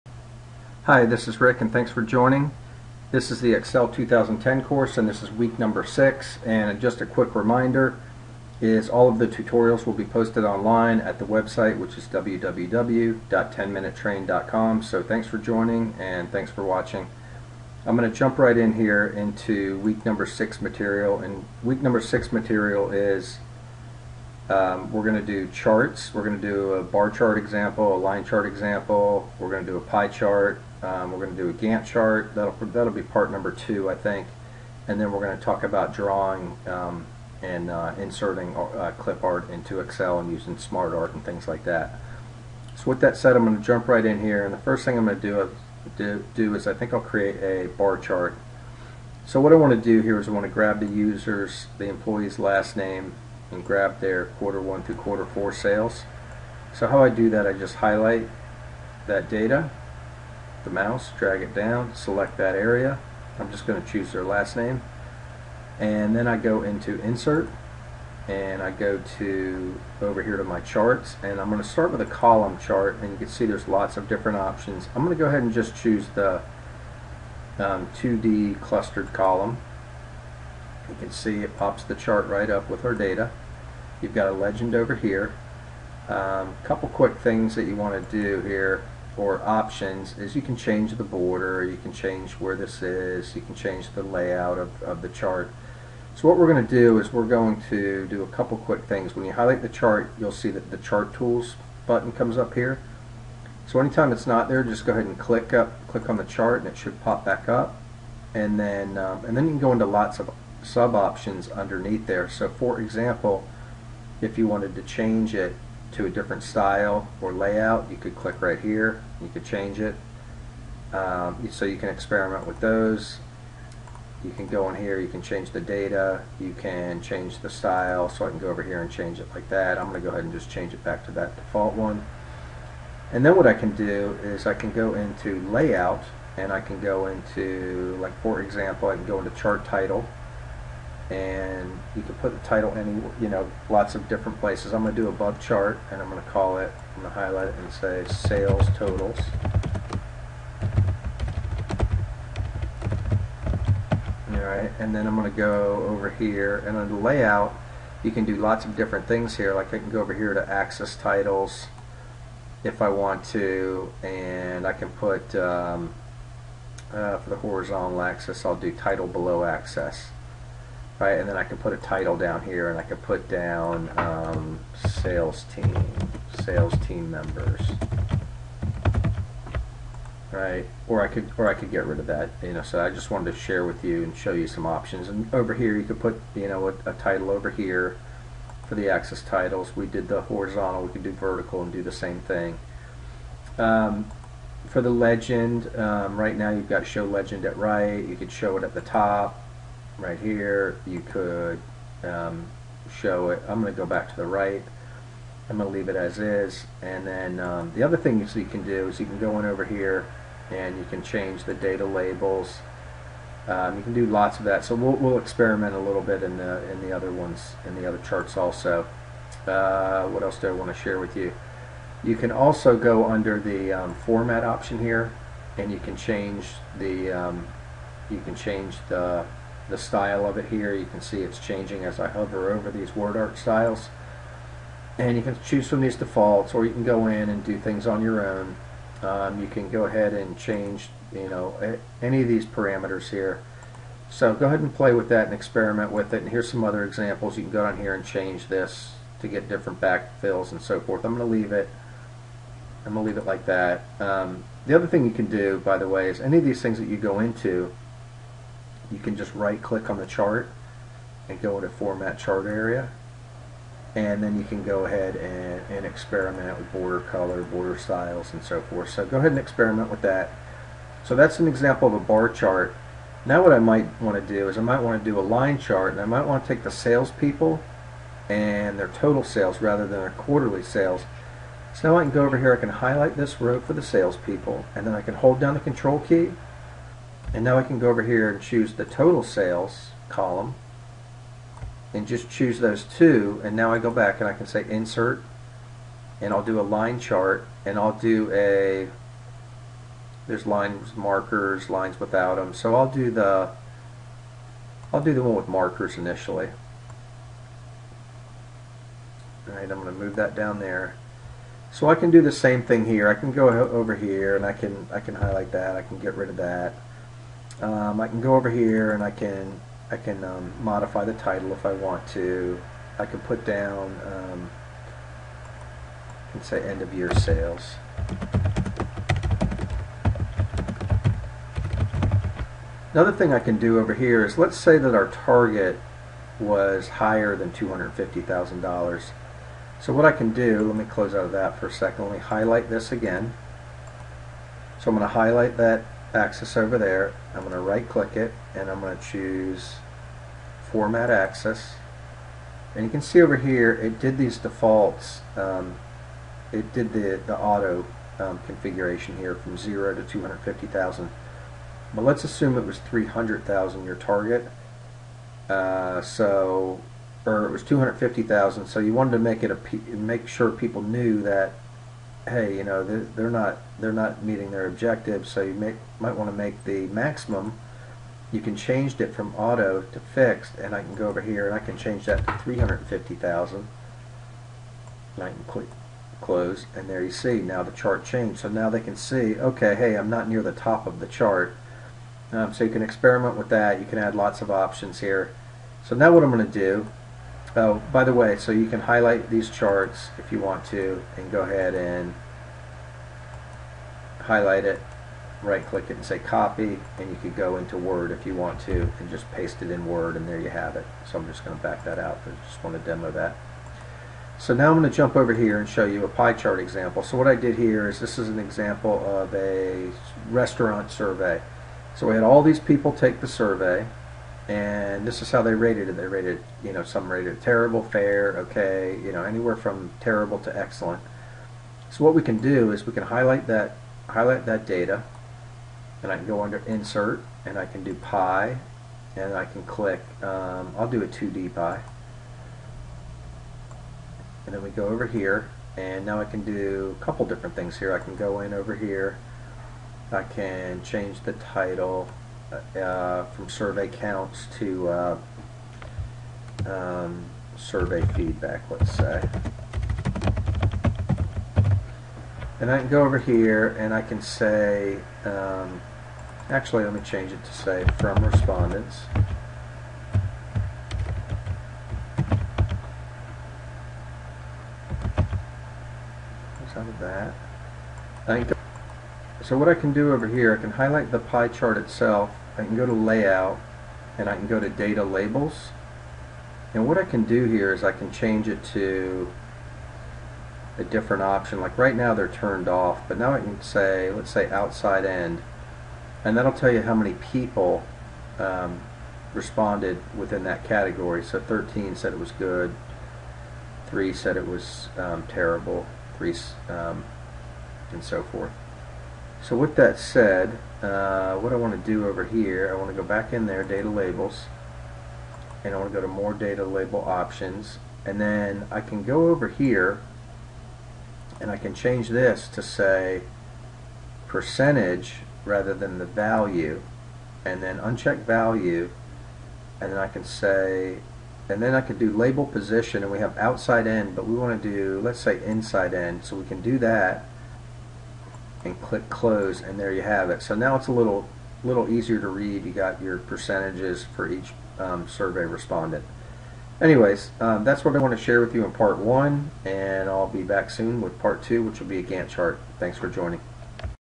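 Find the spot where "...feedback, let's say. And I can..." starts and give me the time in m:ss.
7:38.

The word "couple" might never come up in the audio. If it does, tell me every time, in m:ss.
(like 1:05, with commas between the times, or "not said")
1:26, 1:38, 7:27.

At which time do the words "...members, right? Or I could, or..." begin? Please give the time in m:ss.
2:57.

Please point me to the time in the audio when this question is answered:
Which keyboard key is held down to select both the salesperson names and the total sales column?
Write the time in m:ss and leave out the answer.
4:45.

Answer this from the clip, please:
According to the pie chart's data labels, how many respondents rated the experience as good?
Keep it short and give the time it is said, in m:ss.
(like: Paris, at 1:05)
13, at 8:21.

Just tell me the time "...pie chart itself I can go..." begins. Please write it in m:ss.
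8:01.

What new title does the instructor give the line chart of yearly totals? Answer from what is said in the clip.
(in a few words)
End of year sales.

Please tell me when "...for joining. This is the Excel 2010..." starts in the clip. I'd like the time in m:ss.
0:01.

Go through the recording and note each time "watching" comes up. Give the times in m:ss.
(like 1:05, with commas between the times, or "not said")
0:16.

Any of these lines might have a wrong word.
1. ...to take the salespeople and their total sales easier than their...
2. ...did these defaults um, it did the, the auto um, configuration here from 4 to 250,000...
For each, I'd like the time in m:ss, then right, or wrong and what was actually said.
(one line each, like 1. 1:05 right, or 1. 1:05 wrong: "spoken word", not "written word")
1. 4:36 wrong: "rather", not "easier"
2. 5:53 wrong: "0", not "4".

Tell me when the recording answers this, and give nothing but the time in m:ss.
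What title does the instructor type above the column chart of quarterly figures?
2:28.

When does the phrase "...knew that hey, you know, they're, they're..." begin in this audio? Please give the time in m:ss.
6:10.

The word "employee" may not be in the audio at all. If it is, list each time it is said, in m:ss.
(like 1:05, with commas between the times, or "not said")
0:51.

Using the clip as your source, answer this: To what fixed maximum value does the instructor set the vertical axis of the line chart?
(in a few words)
350,000.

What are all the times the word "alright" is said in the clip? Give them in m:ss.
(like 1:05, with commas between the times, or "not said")
2:34, 5:09.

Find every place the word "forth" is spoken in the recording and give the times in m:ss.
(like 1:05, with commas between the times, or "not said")
4:10, 4:28, 8:28.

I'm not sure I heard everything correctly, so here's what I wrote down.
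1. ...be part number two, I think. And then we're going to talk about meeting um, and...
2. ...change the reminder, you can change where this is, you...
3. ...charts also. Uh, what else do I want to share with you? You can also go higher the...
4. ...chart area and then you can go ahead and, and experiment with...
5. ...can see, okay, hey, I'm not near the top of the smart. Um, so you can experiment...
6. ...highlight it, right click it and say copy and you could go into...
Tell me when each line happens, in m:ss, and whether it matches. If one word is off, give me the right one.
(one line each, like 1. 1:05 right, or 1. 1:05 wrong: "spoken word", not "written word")
1. 0:32 wrong: "drawing", not "meeting"
2. 1:30 wrong: "border", not "reminder"
3. 3:37 wrong: "under", not "higher"
4. 4:22 right
5. 6:28 wrong: "chart", not "smart"
6. 6:44 right.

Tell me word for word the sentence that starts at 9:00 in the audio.
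So now it's a little little easier to read.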